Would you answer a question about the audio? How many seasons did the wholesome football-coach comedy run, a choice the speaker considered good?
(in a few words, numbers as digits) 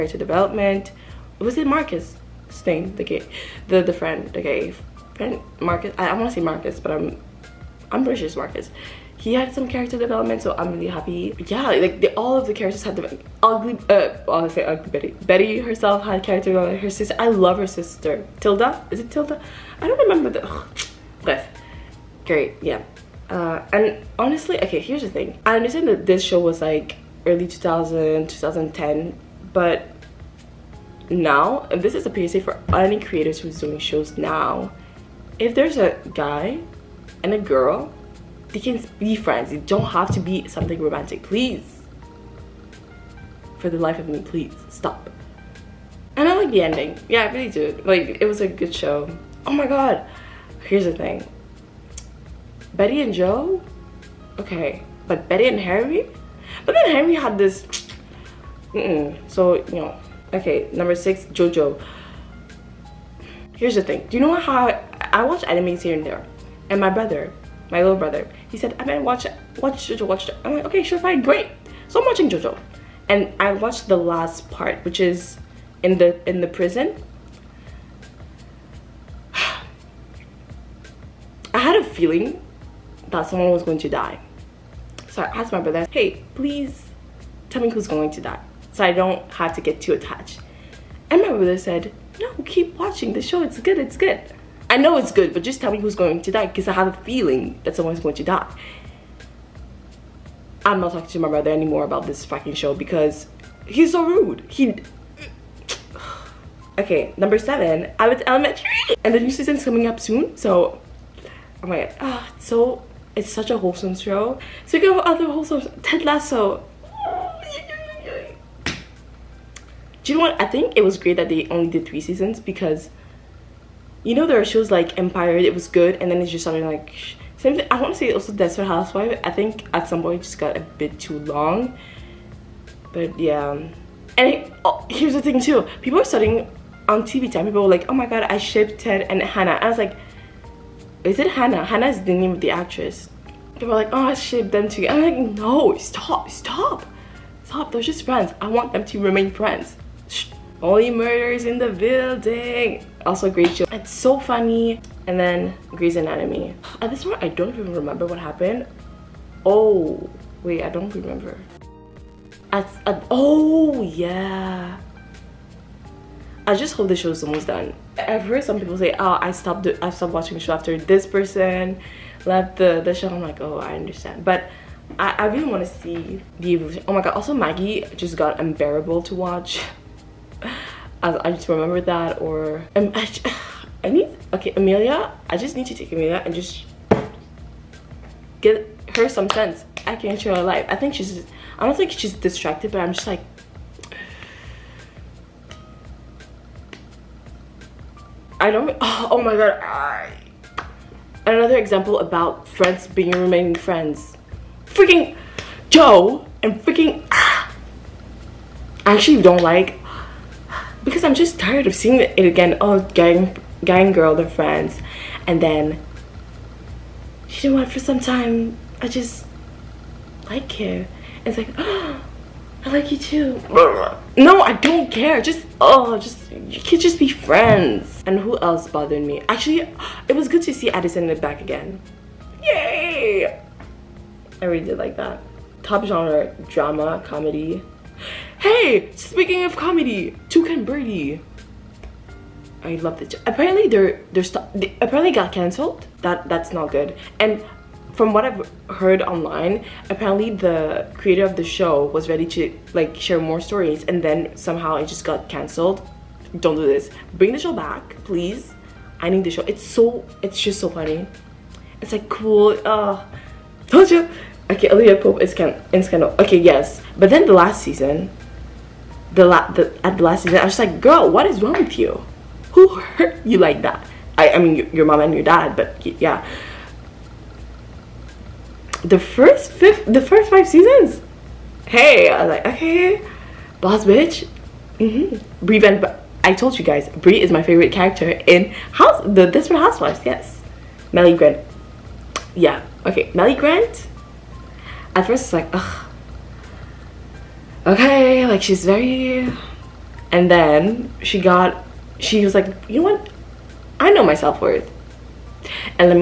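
3.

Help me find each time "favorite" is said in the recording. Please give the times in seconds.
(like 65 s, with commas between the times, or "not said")
287 s.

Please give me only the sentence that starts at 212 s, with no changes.
Oh, gang, gang girl, they're friends.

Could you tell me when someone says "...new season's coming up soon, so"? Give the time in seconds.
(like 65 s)
109 s.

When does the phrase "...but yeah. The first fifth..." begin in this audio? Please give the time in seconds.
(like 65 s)
275 s.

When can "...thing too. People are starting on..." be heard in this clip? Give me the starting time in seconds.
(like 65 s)
135 s.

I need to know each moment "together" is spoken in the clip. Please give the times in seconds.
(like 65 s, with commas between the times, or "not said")
144 s.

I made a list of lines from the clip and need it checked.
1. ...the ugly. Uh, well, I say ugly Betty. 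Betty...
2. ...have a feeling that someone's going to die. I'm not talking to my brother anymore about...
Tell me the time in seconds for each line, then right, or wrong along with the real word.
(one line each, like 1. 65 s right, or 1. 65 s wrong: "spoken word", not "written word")
1. 12 s right
2. 96 s right.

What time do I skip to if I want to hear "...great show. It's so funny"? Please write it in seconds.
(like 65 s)
153 s.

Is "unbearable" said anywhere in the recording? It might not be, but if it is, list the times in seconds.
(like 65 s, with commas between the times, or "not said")
178 s.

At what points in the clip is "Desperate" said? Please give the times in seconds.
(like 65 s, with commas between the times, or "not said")
128 s, 289 s.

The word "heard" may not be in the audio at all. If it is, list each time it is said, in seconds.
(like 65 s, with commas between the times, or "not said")
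168 s, 248 s.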